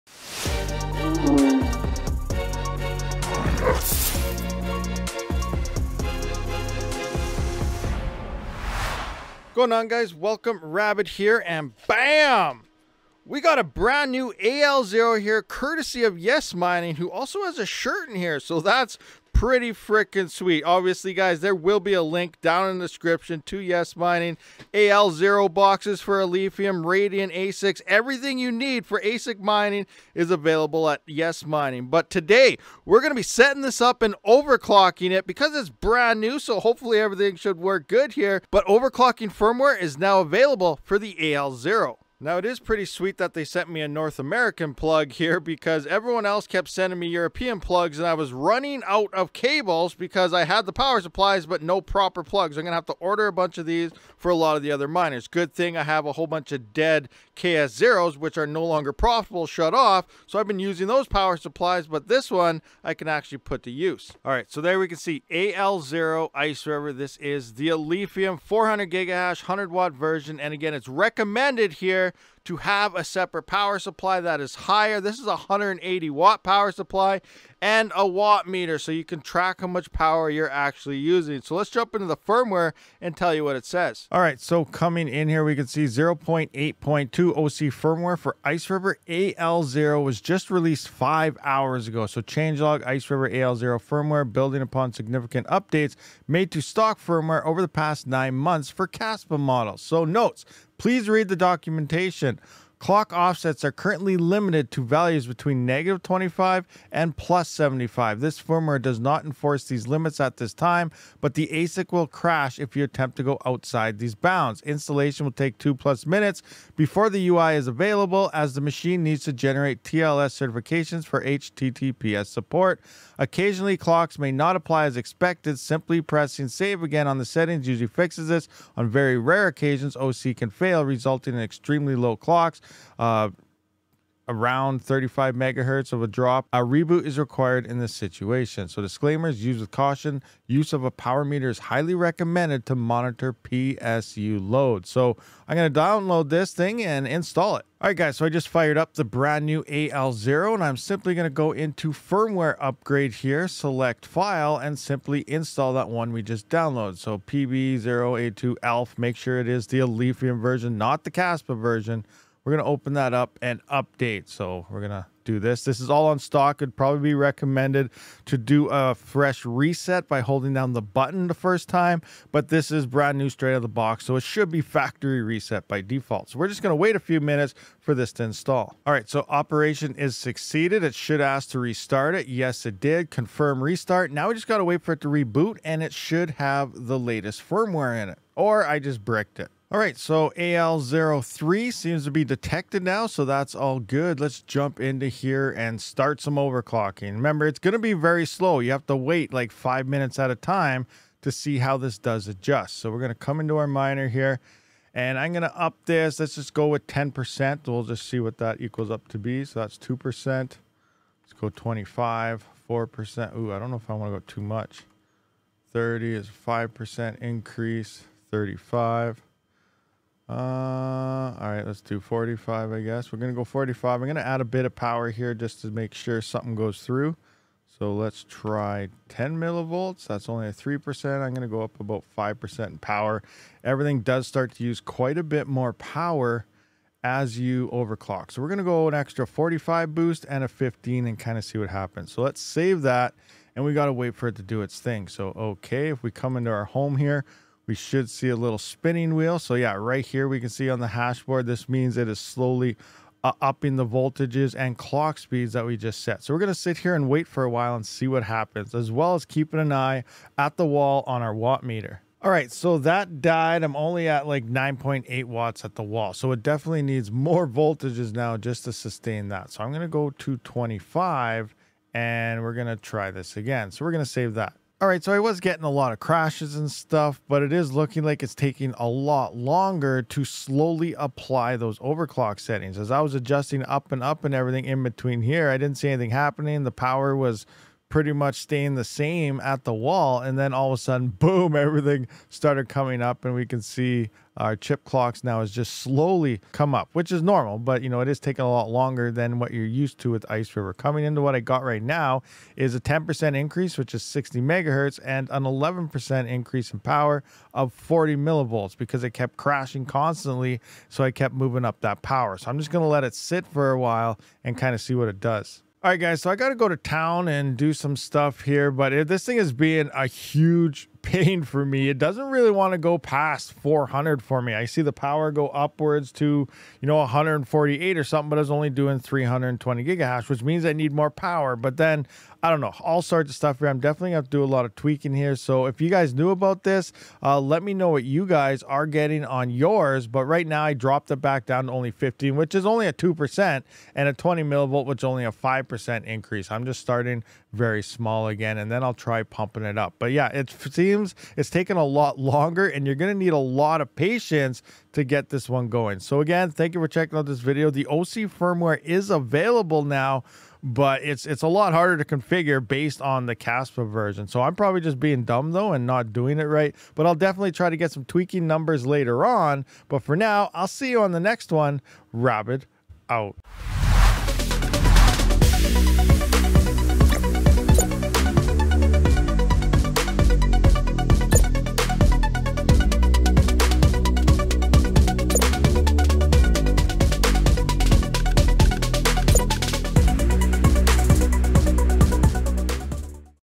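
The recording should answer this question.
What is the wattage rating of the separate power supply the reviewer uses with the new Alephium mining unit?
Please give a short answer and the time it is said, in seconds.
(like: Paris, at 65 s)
180 watt, at 75 s.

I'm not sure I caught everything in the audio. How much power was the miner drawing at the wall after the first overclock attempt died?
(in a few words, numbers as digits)
9.8 watts.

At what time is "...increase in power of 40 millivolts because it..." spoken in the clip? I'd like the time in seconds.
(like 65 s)
306 s.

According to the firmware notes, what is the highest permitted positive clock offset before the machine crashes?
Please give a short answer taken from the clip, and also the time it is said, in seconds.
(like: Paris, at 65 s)
plus 75, at 107 s.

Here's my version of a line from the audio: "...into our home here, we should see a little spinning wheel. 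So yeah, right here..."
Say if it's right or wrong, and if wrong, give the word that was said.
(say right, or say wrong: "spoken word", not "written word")
right.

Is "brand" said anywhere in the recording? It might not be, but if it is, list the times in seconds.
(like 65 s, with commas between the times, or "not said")
13 s, 35 s, 149 s, 172 s.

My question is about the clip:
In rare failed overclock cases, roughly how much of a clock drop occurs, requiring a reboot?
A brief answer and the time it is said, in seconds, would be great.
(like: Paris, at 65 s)
35 megahertz, at 134 s.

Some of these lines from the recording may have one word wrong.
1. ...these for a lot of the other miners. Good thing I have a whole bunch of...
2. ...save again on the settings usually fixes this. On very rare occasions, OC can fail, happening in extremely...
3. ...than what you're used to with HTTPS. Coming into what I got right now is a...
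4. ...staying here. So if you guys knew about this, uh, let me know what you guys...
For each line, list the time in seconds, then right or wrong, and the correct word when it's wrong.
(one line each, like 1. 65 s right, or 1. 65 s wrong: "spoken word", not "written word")
1. 53 s right
2. 126 s wrong: "resulting", not "happening"
3. 299 s wrong: "Iceriver", not "HTTPS"
4. 334 s wrong: "tweaking", not "staying".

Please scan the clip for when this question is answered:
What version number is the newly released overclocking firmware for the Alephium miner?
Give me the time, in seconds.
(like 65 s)
85 s.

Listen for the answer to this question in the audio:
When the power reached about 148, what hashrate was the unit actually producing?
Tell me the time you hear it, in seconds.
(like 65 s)
328 s.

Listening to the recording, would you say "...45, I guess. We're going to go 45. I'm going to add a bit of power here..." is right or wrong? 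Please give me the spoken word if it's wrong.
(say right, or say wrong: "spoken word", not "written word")
right.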